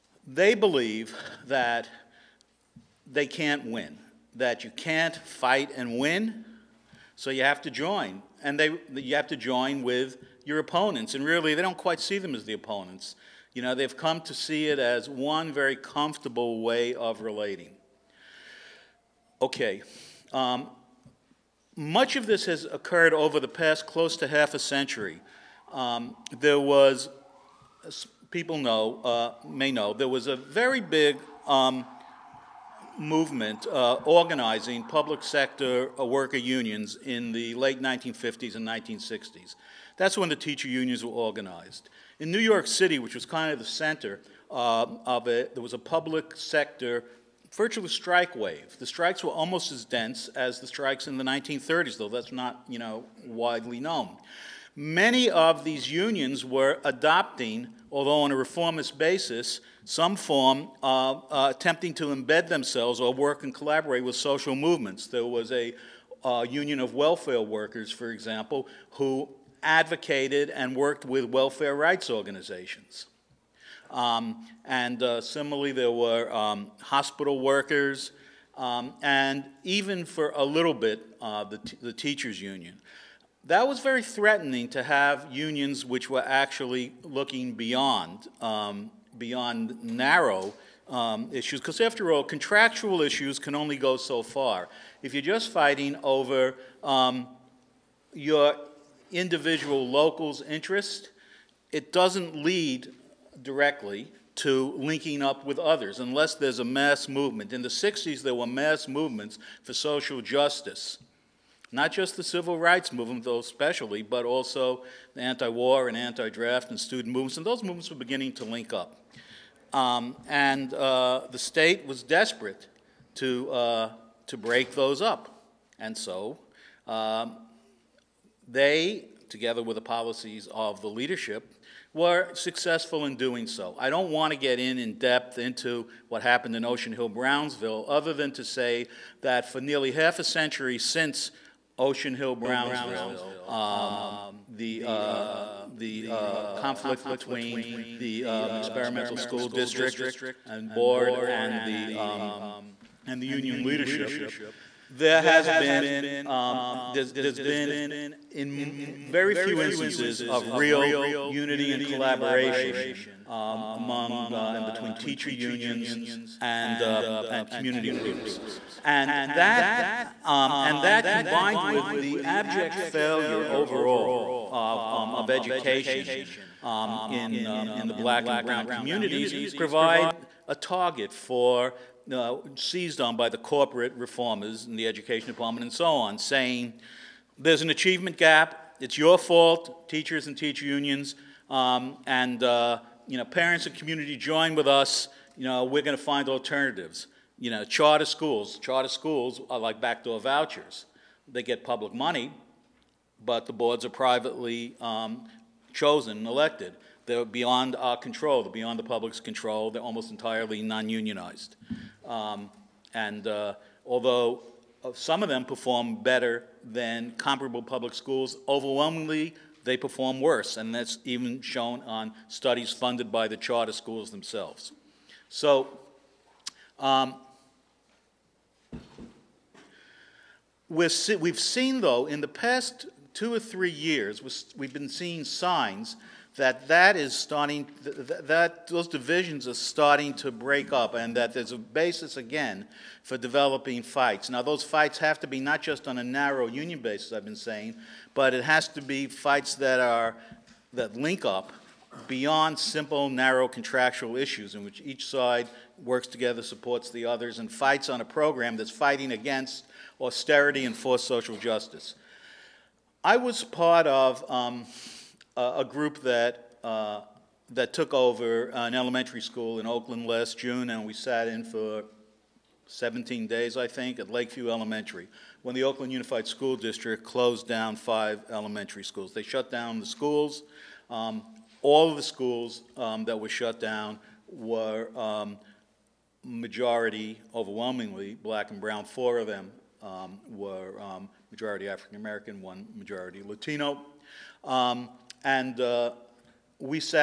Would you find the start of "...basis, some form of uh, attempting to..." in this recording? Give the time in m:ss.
0:58.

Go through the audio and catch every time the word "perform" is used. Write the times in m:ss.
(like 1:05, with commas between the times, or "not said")
3:35, 3:39.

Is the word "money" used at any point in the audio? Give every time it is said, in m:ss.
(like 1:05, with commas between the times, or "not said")
3:21.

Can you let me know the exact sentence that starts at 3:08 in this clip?
It's your fault, teachers and teacher unions, um, and uh, you know, parents and community join with us.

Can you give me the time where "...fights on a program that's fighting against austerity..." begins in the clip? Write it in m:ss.
4:17.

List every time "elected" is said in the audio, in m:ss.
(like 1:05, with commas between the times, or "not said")
3:26.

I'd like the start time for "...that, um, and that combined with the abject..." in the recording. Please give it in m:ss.
2:49.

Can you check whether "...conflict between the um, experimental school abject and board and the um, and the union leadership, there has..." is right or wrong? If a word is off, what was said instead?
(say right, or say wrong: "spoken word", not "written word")
wrong: "district", not "abject".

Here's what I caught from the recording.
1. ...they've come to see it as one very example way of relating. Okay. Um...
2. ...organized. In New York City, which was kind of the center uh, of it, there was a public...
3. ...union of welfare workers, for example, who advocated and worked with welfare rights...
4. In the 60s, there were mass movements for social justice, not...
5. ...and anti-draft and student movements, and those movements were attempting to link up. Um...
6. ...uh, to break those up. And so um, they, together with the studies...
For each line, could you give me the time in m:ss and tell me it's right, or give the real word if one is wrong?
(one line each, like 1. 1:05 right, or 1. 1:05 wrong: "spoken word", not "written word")
1. 0:13 wrong: "comfortable", not "example"
2. 0:41 right
3. 1:06 right
4. 1:47 right
5. 1:55 wrong: "beginning", not "attempting"
6. 2:03 wrong: "policies", not "studies".